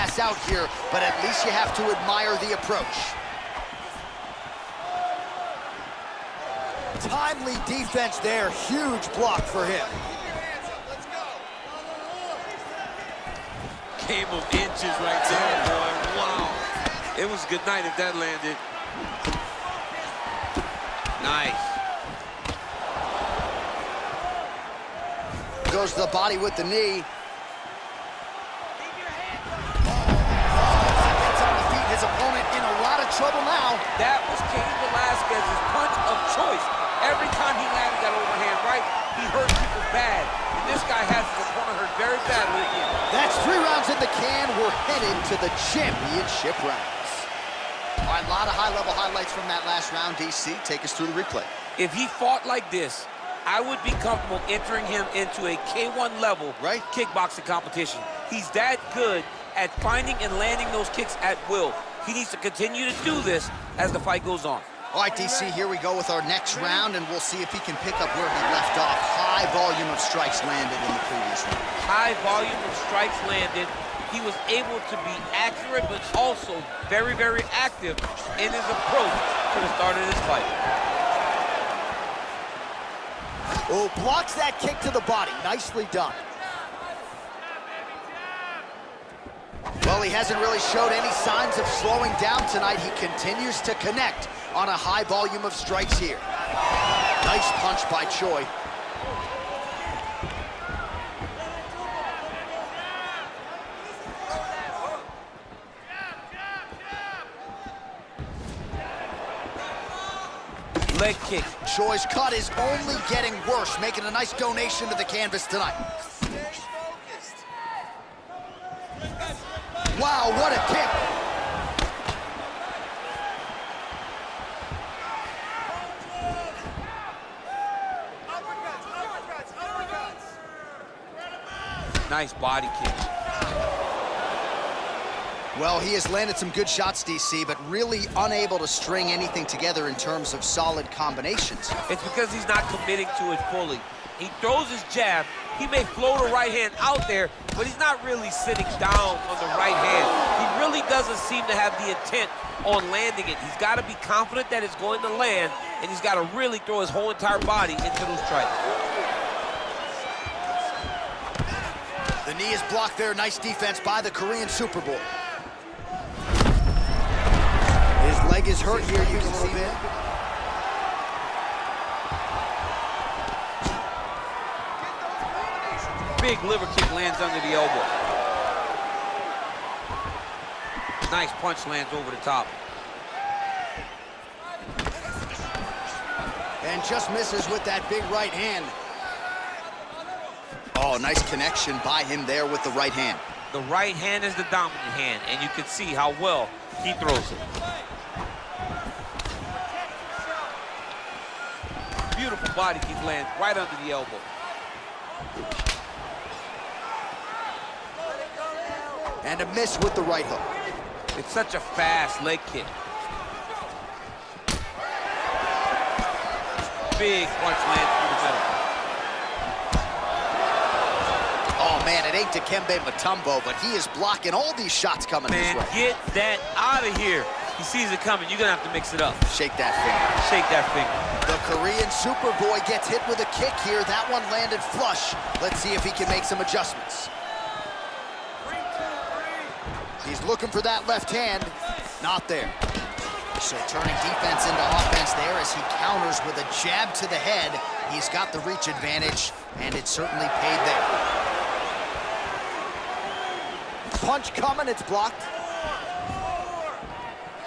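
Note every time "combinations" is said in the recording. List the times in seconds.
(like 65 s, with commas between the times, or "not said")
140 s.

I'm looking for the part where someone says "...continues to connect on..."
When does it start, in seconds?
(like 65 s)
93 s.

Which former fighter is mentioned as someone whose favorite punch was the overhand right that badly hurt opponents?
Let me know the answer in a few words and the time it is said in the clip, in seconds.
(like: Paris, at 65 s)
Cain Velasquez, at 34 s.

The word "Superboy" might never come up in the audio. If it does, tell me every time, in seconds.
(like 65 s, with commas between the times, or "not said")
164 s, 232 s.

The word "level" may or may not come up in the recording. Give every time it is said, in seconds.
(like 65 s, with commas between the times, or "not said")
48 s, 56 s.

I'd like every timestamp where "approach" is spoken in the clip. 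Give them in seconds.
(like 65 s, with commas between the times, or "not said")
2 s, 78 s.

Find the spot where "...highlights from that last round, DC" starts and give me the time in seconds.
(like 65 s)
48 s.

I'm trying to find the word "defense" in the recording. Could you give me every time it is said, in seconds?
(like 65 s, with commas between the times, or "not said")
7 s, 163 s, 244 s.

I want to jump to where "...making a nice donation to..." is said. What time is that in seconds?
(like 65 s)
113 s.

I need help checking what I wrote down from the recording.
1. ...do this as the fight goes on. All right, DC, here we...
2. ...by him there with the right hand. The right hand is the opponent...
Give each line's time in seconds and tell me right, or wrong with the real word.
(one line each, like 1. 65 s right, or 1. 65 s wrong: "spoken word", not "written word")
1. 63 s right
2. 191 s wrong: "dominant", not "opponent".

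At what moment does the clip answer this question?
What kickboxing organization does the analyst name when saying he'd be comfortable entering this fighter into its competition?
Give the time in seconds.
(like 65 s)
55 s.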